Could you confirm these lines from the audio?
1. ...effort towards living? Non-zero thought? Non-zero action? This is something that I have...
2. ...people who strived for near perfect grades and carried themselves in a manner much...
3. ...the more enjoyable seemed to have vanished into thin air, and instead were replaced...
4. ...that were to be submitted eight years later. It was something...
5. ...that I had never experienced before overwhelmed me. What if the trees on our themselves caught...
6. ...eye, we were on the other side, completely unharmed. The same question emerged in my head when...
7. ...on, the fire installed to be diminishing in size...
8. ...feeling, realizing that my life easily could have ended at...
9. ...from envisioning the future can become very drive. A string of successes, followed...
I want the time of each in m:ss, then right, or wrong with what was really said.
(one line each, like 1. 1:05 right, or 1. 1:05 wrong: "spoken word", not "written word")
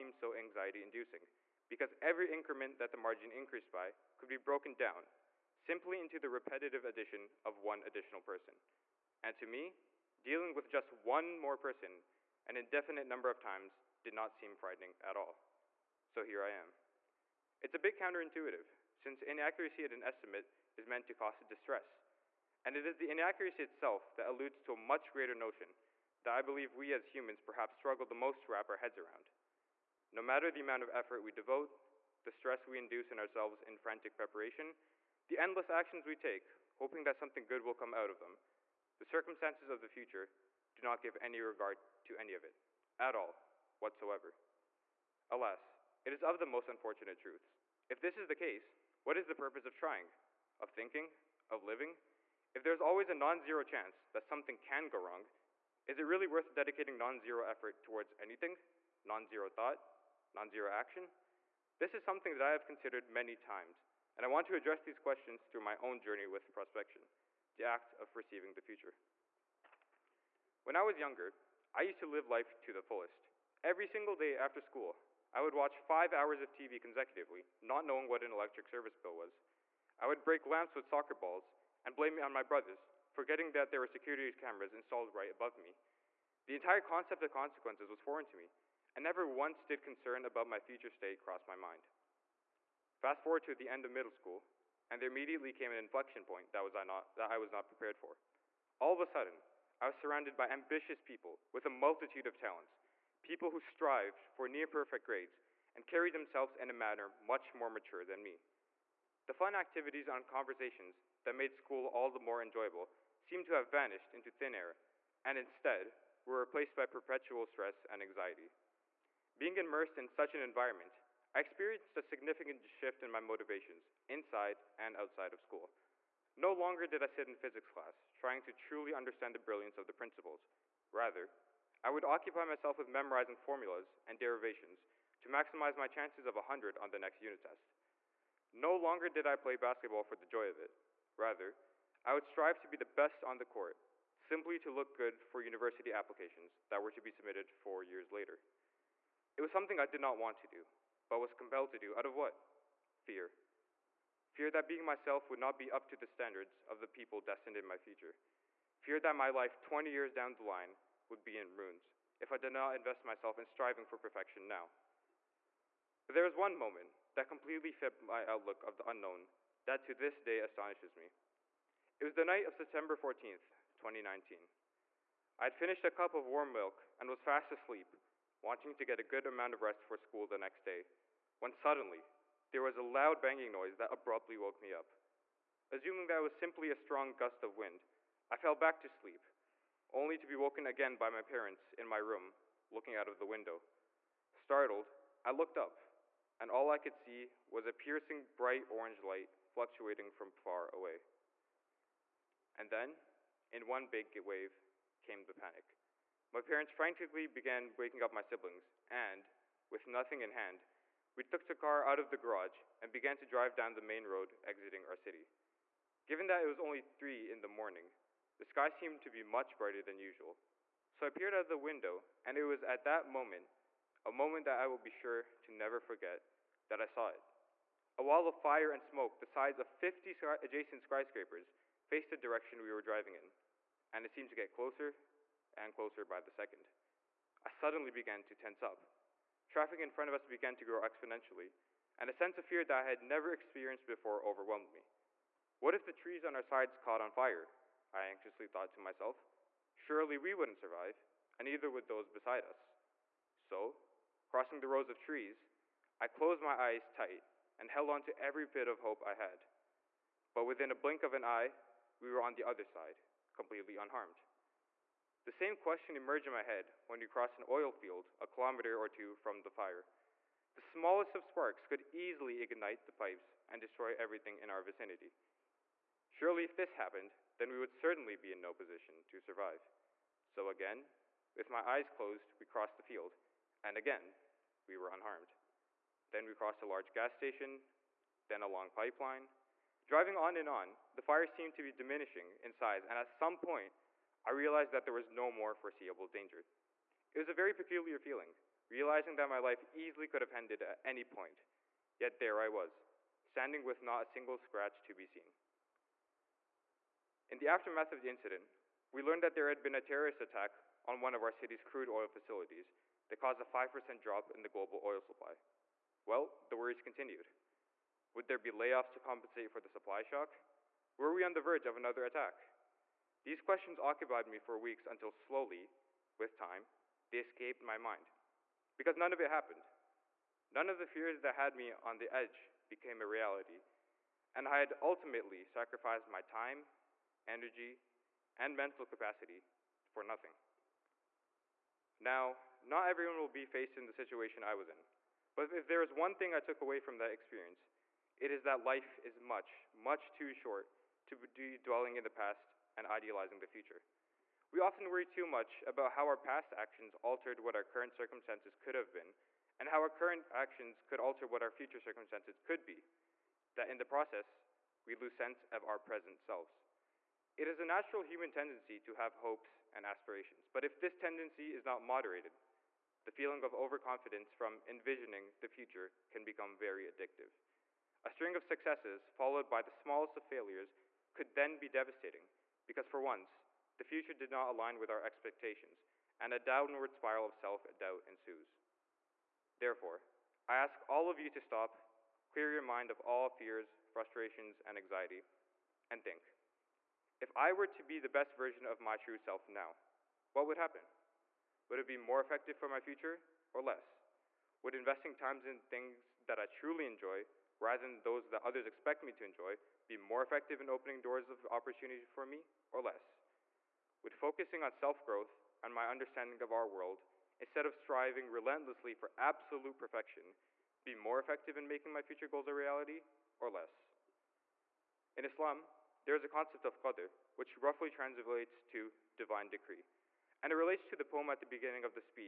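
1. 0:57 wrong: "anything", not "living"
2. 1:43 right
3. 1:52 right
4. 2:26 wrong: "four", not "eight"
5. 4:02 wrong: "sides", not "themselves"
6. 4:21 right
7. 4:50 wrong: "seemed", not "installed"
8. 4:57 right
9. 6:14 wrong: "addictive", not "drive".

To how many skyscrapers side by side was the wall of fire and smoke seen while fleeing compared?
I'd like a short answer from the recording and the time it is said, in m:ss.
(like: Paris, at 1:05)
50, at 3:49.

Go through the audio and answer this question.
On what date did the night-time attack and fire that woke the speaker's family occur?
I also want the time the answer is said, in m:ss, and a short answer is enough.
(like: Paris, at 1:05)
September 14th, 2019, at 2:52.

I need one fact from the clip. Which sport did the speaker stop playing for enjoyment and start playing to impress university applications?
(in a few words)
Basketball.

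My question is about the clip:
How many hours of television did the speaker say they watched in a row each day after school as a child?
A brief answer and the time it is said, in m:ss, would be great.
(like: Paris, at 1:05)
5, at 1:15.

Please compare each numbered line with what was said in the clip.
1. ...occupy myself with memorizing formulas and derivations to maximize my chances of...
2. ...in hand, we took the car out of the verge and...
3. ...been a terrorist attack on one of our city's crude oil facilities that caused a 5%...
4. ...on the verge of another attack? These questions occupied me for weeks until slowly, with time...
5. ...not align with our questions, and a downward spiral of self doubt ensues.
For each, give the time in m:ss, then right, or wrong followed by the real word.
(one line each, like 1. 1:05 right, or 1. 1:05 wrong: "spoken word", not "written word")
1. 2:12 right
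2. 3:30 wrong: "garage", not "verge"
3. 5:09 right
4. 5:21 right
5. 6:24 wrong: "expectations", not "questions".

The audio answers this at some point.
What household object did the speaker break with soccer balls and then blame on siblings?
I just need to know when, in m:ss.
1:20.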